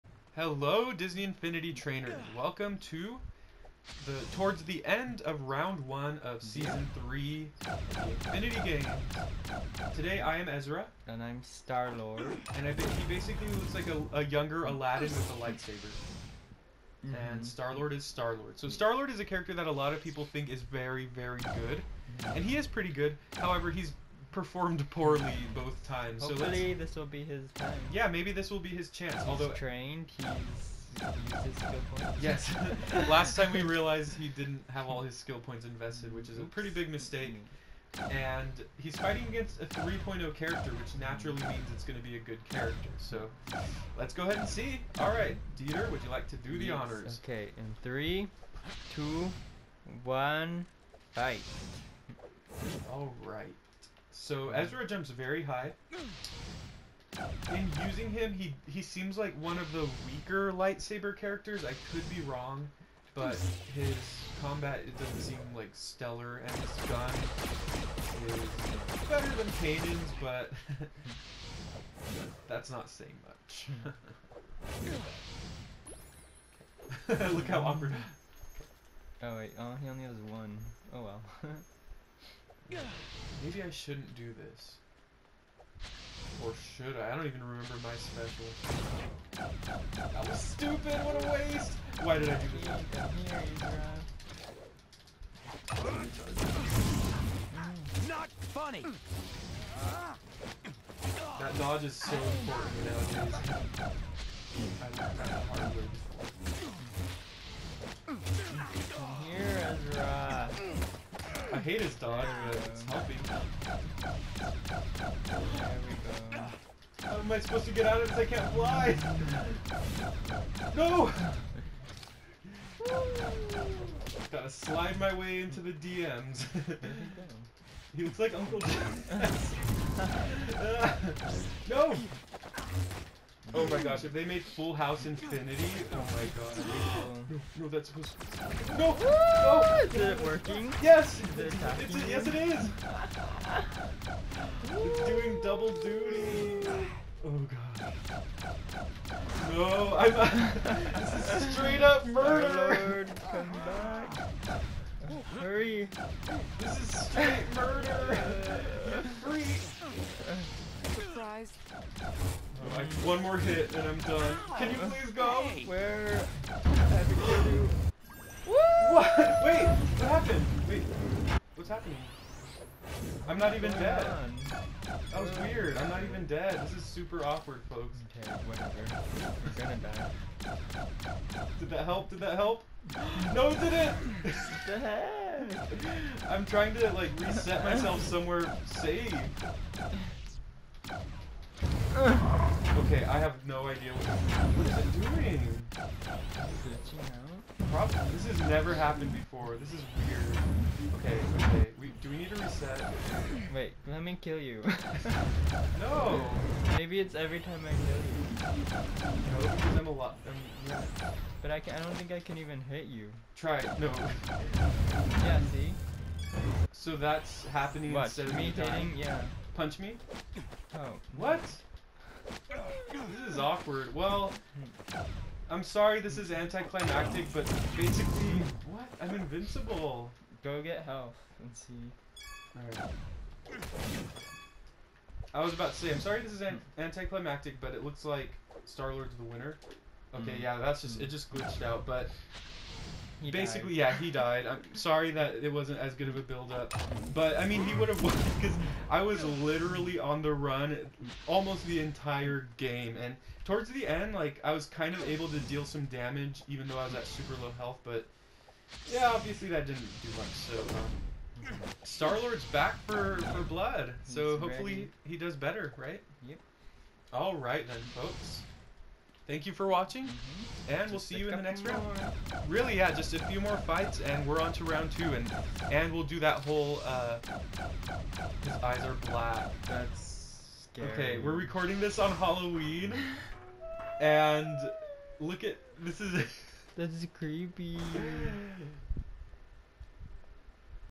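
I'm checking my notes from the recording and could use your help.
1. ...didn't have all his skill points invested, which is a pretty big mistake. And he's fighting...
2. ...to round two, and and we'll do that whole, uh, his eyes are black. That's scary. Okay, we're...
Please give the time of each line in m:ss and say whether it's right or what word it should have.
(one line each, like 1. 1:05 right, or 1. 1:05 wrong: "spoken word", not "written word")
1. 0:34 right
2. 4:34 right.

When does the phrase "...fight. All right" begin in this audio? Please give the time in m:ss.
0:51.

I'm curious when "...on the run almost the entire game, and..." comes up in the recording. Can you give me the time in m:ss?
4:09.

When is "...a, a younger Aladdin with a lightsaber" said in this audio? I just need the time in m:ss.
0:13.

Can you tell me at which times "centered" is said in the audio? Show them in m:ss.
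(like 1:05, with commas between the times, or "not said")
not said.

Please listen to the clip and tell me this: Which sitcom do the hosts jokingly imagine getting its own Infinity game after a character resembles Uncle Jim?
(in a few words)
Full House.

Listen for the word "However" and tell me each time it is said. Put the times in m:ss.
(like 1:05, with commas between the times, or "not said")
0:23.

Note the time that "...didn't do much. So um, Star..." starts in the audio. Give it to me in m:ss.
4:19.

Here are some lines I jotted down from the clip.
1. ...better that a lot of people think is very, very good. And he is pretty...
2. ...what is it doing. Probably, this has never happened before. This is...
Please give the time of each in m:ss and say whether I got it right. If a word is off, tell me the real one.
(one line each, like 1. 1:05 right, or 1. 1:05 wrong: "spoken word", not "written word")
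1. 0:19 wrong: "character", not "better"
2. 3:14 right.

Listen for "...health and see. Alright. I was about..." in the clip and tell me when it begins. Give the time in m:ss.
3:50.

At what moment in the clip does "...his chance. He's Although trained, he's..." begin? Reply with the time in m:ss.
0:28.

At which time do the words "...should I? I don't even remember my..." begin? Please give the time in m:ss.
1:26.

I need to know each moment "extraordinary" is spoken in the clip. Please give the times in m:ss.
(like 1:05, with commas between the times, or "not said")
not said.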